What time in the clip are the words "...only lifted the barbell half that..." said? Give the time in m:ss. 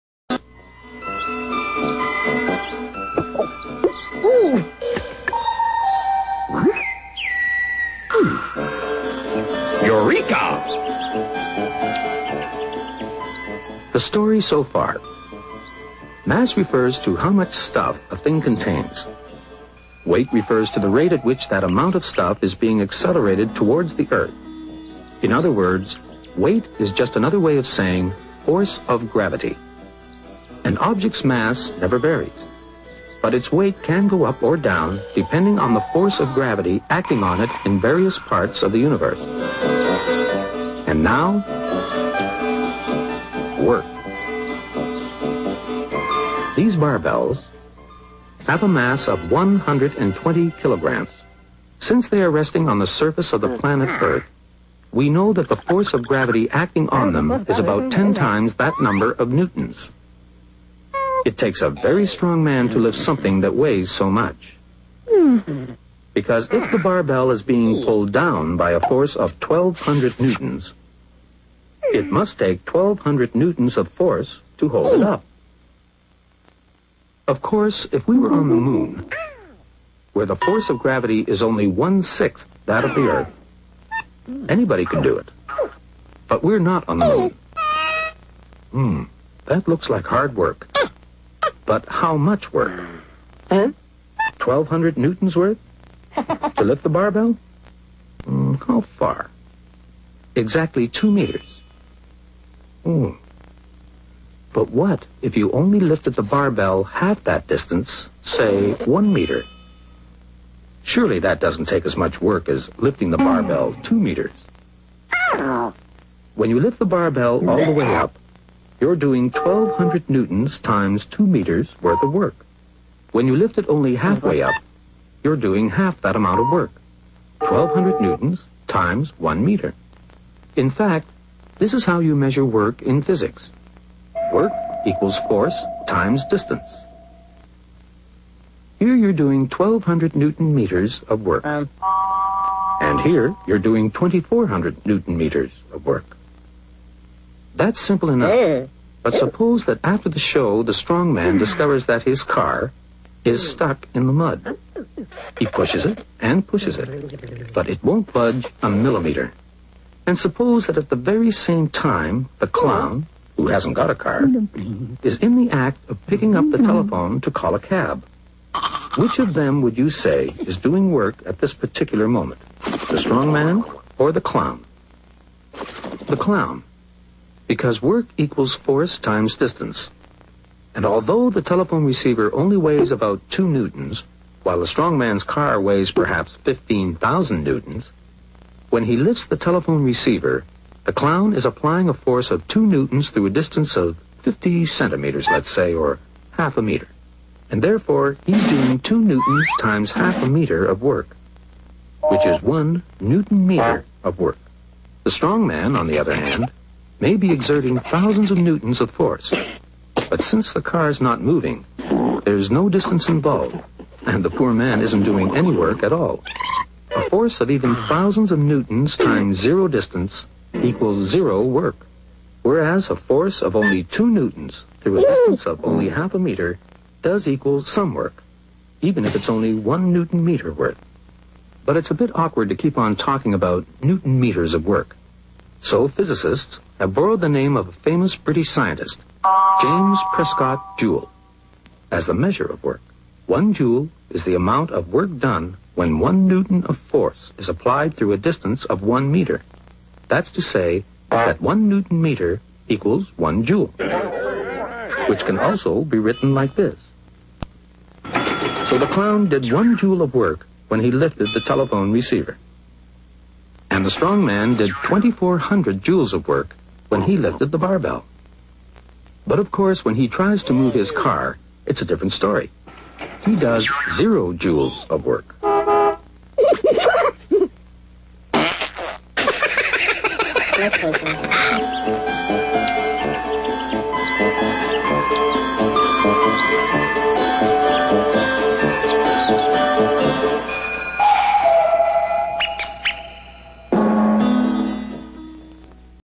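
1:45.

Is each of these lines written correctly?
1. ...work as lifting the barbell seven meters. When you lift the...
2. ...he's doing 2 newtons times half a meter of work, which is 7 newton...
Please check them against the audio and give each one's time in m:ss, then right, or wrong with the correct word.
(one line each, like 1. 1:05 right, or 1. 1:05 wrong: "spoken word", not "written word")
1. 1:52 wrong: "two", not "seven"
2. 3:18 wrong: "1", not "7".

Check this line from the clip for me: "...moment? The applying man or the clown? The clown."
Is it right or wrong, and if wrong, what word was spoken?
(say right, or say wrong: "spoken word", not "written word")
wrong: "strong", not "applying".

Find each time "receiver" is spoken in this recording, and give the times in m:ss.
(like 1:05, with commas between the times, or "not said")
3:01, 3:09, 4:21.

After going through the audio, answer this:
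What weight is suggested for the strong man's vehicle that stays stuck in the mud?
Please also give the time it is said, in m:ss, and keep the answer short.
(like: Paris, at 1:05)
15,000 newtons, at 3:06.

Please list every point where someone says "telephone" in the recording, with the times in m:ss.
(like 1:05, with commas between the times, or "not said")
2:46, 3:01, 3:09, 4:21.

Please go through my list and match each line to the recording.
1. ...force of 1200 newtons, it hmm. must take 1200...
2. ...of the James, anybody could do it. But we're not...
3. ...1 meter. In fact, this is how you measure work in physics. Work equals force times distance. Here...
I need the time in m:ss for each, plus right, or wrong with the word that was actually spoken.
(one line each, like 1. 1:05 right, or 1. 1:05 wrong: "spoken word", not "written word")
1. 1:08 right
2. 1:22 wrong: "Earth", not "James"
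3. 2:09 right.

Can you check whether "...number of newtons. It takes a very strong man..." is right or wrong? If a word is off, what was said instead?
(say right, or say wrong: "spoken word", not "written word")
right.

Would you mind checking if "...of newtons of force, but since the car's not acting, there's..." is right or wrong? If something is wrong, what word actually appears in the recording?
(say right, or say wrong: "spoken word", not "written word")
wrong: "moving", not "acting".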